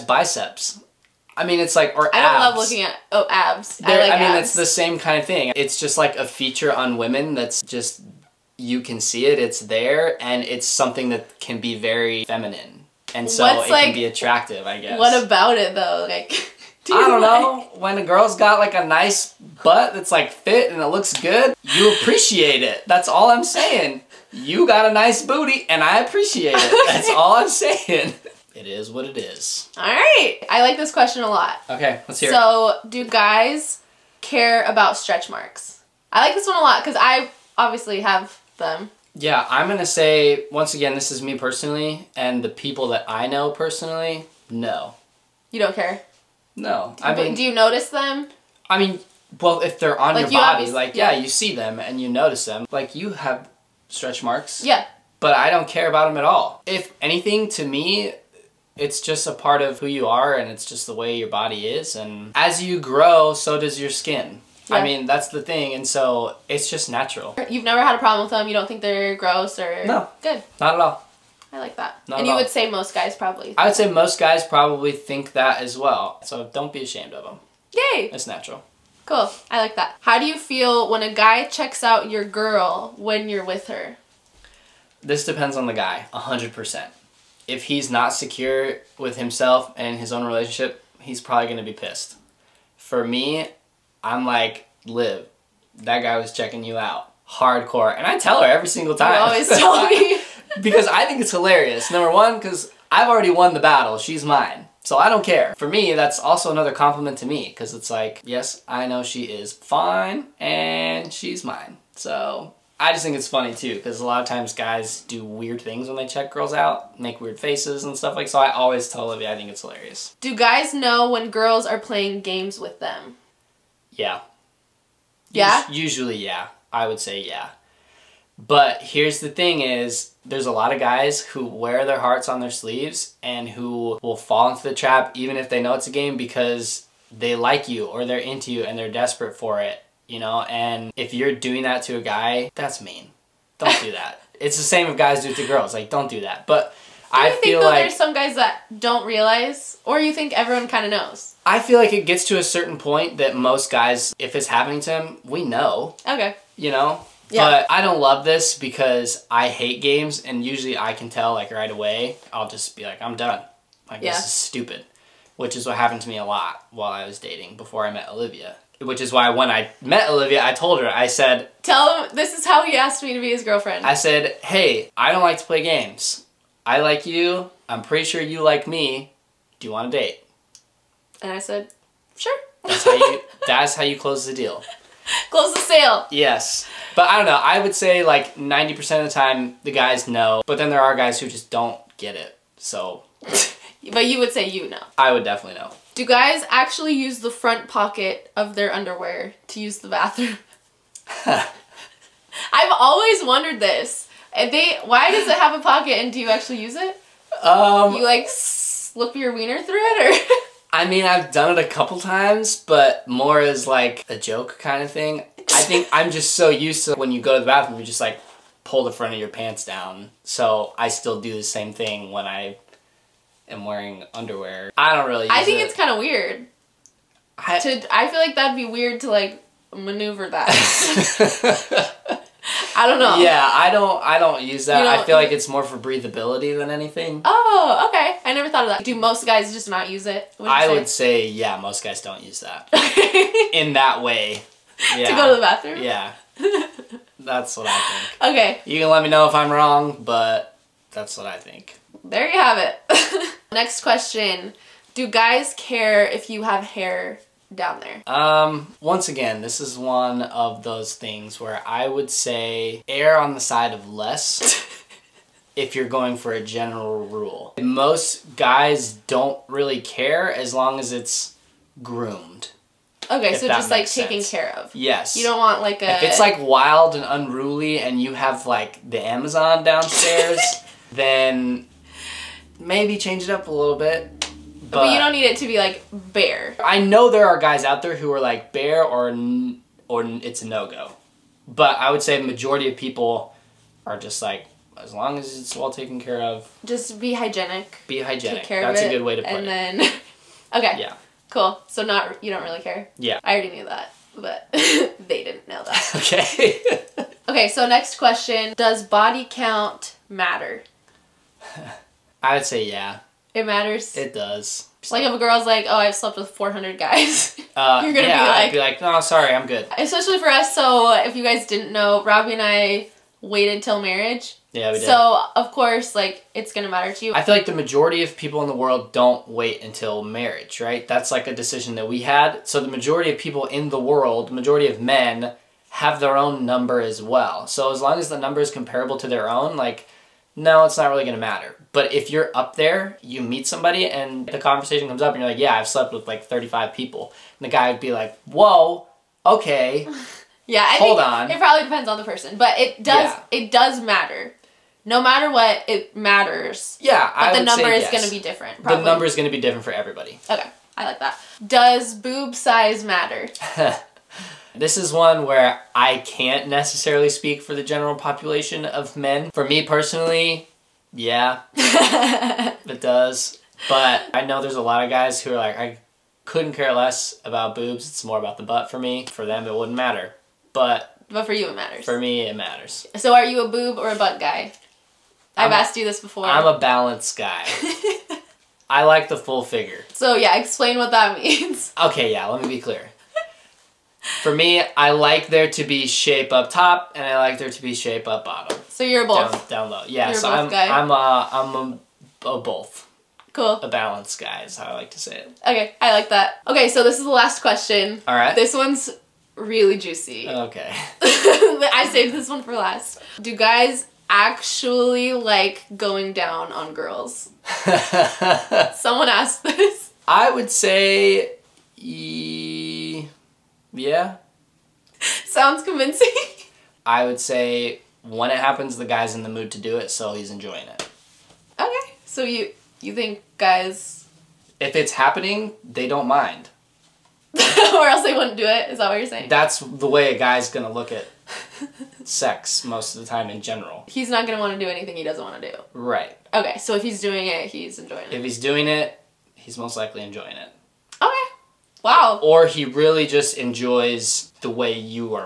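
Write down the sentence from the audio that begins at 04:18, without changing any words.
Um, once again, this is one of those things where I would say err on the side of less.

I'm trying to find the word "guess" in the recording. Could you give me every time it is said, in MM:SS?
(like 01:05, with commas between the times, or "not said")
00:14.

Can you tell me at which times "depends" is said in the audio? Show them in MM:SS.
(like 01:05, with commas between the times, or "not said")
01:25, 05:51.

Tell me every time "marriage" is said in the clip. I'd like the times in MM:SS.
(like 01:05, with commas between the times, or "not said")
05:23, 05:30.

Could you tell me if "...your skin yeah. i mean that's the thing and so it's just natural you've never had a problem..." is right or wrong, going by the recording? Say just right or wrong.
right.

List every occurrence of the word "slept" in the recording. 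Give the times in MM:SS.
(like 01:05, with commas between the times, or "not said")
05:15, 05:45.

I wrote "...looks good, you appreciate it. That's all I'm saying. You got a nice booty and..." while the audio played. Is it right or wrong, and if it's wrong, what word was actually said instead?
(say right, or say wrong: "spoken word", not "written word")
right.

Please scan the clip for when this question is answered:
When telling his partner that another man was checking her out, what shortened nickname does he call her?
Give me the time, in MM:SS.
01:34.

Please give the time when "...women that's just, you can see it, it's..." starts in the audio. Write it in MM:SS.
00:06.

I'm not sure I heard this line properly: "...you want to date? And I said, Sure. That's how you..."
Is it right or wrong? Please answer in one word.
right.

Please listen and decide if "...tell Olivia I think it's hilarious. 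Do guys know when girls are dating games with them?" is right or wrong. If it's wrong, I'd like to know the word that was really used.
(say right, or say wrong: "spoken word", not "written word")
wrong: "playing", not "dating".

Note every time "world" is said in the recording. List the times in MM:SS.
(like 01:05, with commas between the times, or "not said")
05:28, 05:33.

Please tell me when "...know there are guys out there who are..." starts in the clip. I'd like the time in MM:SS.
04:46.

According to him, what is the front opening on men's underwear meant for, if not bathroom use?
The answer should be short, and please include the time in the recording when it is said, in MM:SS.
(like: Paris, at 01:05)
Breathability, at 03:55.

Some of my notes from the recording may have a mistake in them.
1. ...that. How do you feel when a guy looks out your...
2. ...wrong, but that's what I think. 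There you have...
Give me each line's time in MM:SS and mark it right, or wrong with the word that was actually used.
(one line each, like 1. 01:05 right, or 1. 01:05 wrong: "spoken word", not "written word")
1. 01:19 wrong: "checks", not "looks"
2. 04:09 right.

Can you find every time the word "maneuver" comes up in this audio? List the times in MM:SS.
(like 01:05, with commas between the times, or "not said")
03:49.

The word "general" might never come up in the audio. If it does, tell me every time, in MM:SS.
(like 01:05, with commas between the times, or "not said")
04:26, 06:07, 07:23.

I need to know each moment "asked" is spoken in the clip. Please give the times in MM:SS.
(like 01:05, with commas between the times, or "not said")
02:52, 06:25, 06:59.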